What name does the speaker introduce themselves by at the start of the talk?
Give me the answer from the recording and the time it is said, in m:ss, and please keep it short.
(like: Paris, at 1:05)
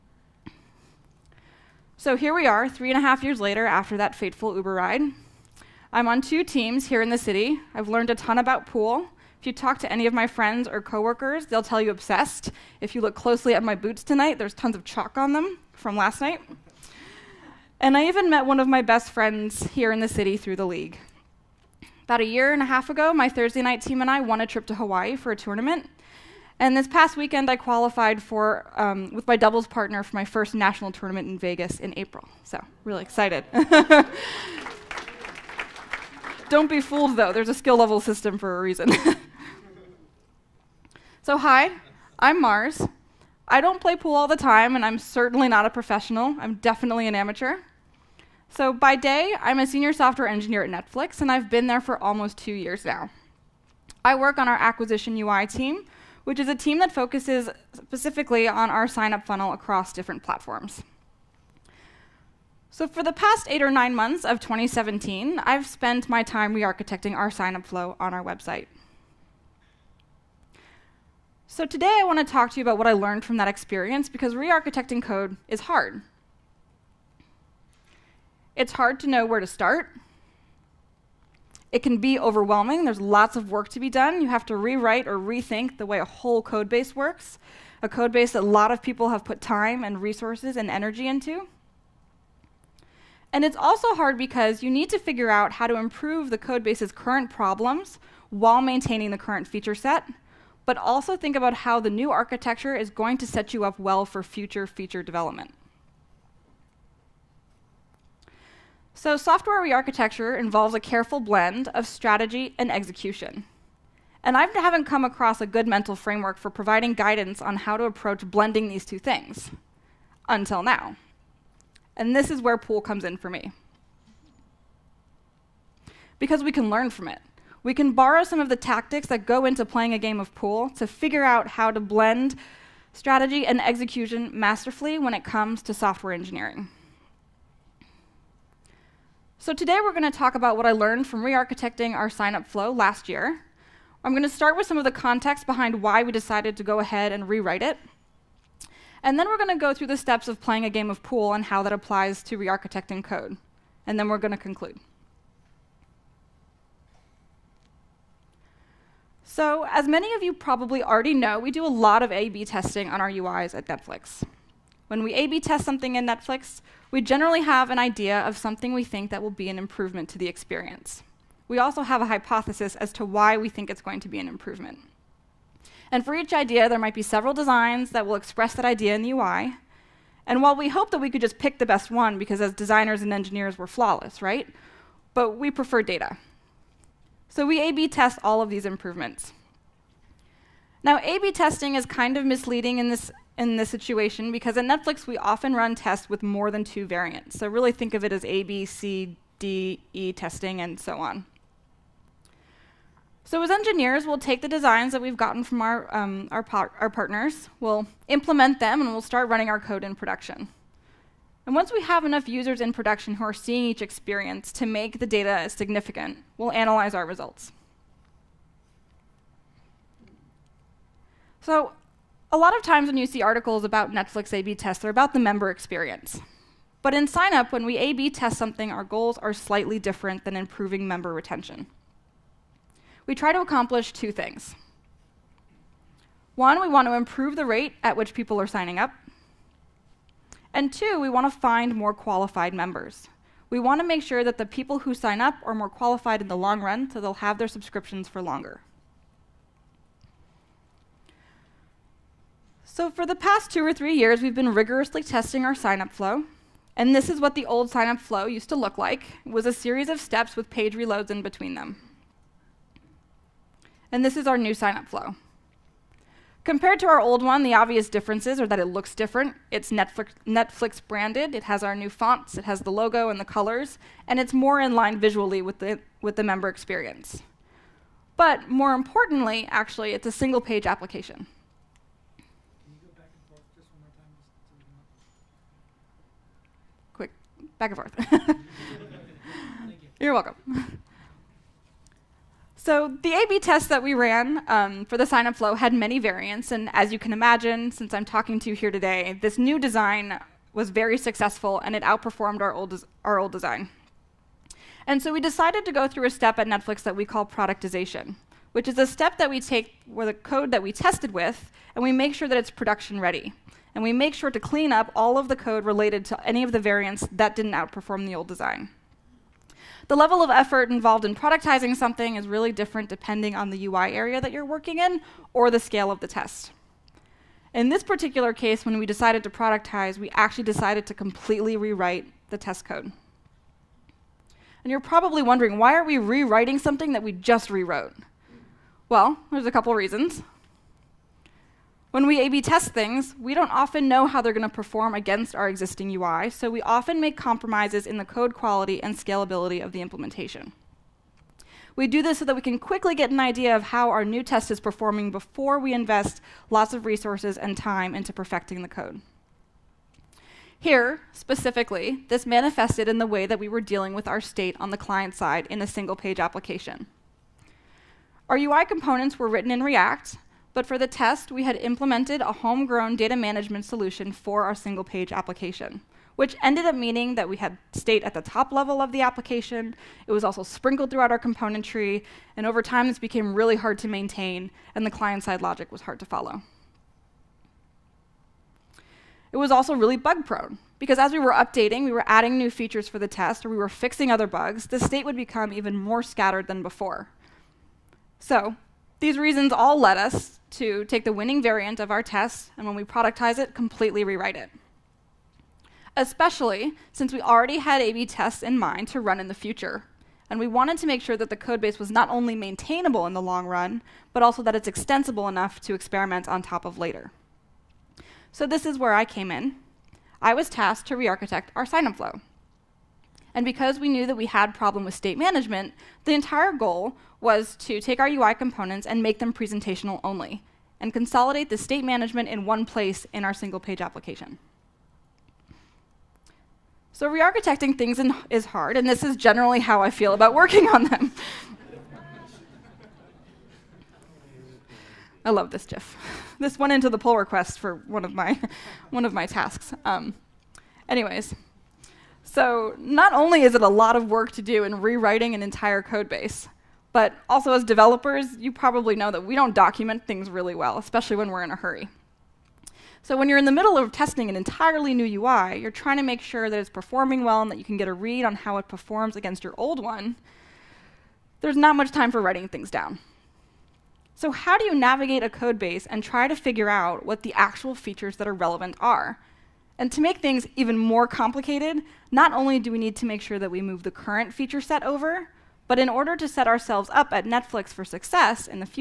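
Mars, at 0:42.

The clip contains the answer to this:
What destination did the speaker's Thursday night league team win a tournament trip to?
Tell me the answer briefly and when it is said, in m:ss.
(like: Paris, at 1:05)
Hawaii, at 0:24.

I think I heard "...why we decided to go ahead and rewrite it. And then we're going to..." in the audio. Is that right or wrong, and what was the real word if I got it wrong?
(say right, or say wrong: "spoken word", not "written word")
right.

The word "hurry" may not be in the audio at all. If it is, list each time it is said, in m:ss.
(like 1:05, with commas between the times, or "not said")
7:41.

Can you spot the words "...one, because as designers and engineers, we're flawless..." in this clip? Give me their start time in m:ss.
3:01.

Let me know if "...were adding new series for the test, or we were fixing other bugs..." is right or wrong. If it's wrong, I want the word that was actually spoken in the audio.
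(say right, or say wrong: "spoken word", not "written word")
wrong: "features", not "series".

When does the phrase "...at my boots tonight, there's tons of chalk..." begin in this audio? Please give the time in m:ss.
0:13.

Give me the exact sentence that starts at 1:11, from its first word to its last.
So today I want to talk to you about what I learned from that experience because re-architecting code is hard.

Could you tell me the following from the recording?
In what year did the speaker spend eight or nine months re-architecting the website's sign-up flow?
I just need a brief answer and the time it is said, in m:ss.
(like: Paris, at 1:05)
2017, at 1:04.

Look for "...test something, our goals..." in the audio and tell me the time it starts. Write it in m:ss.
3:48.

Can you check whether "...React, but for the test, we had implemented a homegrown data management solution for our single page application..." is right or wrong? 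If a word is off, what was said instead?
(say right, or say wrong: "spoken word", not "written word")
right.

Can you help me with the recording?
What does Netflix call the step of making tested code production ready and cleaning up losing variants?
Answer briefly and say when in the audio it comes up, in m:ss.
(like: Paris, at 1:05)
productization, at 5:07.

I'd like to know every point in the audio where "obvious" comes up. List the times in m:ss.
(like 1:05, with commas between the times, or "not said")
4:27.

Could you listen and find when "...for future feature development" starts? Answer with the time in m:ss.
1:44.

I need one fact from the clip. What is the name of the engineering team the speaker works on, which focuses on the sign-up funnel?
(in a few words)
acquisition UI team.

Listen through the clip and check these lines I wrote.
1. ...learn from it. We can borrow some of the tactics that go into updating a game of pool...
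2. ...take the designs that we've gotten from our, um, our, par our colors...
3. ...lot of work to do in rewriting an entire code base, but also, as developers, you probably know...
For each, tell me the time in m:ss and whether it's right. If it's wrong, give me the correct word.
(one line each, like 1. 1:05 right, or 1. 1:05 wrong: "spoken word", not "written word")
1. 2:06 wrong: "playing", not "updating"
2. 3:24 wrong: "partners", not "colors"
3. 7:33 right.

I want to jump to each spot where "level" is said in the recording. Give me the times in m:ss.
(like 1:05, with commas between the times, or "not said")
0:37, 5:19, 6:18.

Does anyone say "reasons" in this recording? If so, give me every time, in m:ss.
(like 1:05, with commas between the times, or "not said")
0:38, 5:39, 6:39.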